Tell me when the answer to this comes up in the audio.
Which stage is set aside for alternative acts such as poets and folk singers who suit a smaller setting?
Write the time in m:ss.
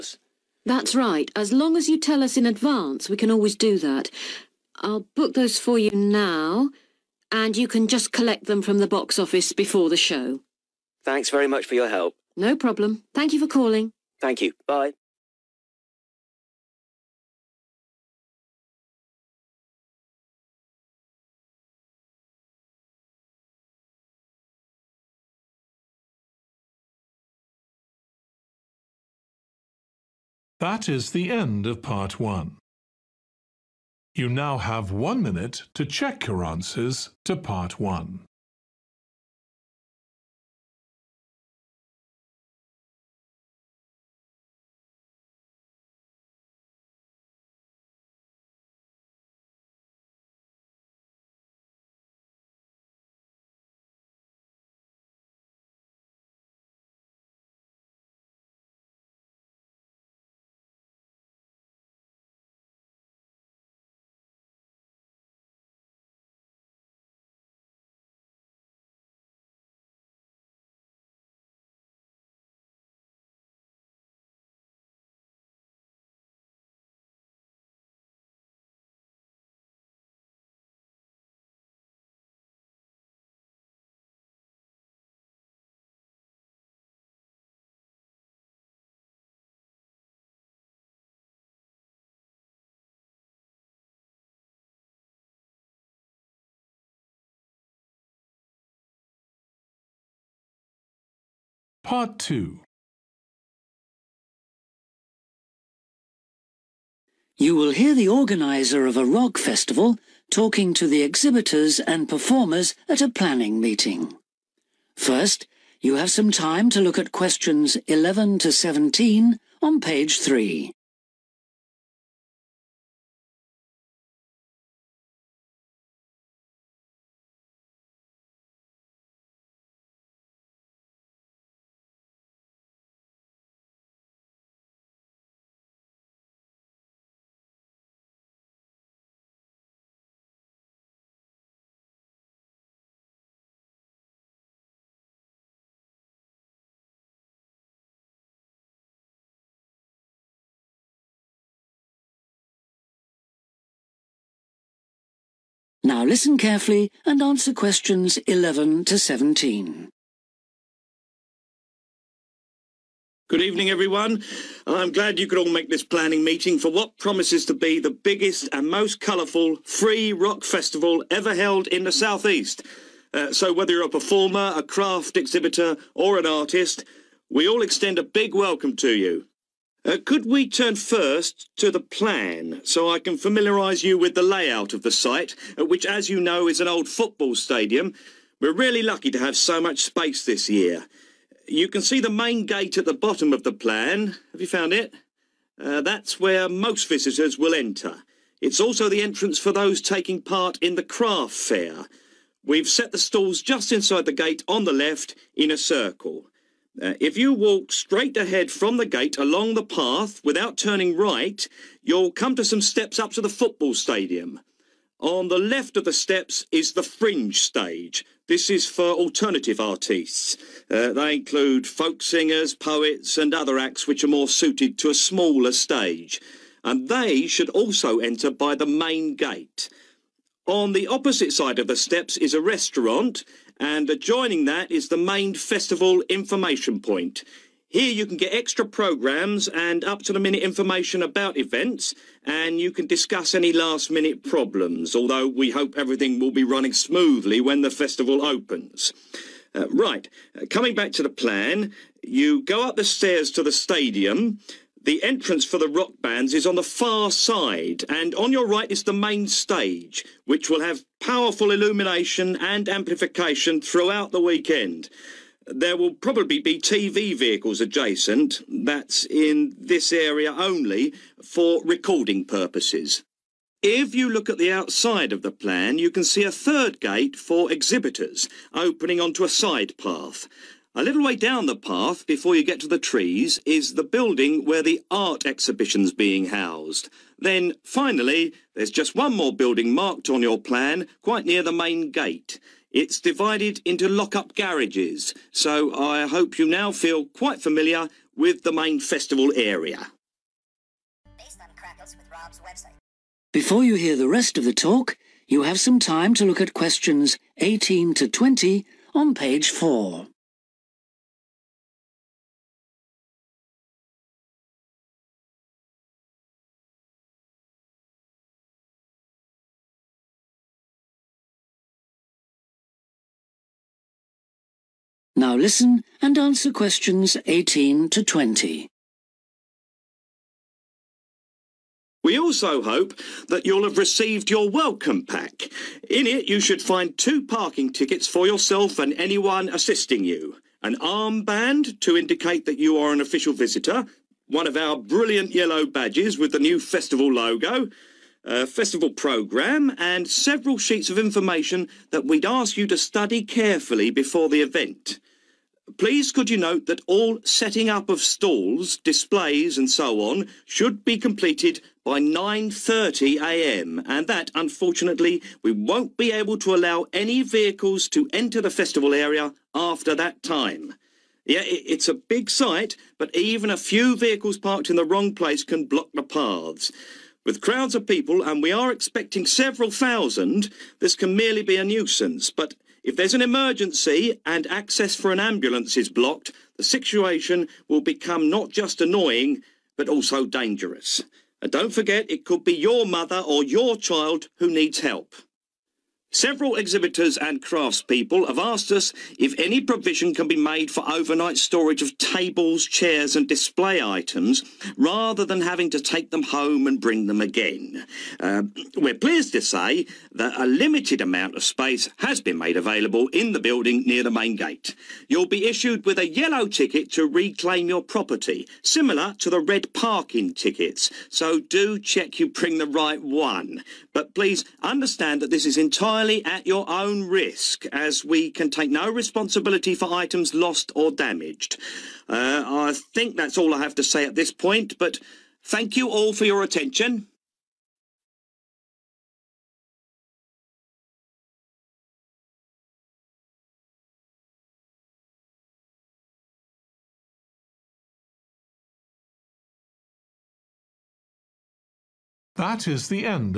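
3:36.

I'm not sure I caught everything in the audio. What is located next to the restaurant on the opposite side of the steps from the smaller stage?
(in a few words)
main festival information point.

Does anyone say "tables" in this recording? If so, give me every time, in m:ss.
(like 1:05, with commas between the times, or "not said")
6:41.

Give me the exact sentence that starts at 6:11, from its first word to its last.
Yeah, it's a big site, but even a few vehicles parked in the wrong place can block the paths.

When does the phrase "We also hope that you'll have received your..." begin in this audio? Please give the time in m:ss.
5:32.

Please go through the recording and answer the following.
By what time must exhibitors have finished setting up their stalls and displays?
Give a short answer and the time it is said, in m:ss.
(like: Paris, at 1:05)
9.30am, at 6:01.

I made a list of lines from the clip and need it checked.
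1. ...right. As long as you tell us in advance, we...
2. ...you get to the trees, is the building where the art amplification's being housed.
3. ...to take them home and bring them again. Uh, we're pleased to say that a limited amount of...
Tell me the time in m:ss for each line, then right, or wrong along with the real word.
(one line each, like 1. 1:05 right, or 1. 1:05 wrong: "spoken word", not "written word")
1. 0:00 right
2. 4:42 wrong: "exhibition", not "amplification"
3. 6:45 right.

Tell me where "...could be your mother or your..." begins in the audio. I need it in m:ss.
6:32.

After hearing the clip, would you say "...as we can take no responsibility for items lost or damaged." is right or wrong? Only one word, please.
right.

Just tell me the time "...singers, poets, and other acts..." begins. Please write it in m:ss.
3:42.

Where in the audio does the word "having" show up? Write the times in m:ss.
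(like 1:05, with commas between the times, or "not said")
6:45.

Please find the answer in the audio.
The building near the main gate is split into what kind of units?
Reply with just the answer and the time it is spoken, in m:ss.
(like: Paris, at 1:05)
lock-up garages, at 4:53.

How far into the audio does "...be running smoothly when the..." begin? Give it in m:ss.
4:06.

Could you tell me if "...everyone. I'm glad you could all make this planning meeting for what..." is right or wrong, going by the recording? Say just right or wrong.
right.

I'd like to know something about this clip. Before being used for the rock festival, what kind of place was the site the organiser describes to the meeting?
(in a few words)
old football stadium.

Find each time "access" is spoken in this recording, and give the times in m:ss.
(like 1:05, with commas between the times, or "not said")
6:24.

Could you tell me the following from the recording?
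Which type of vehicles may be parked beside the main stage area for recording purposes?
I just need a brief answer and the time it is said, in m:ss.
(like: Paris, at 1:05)
TV vehicles, at 4:26.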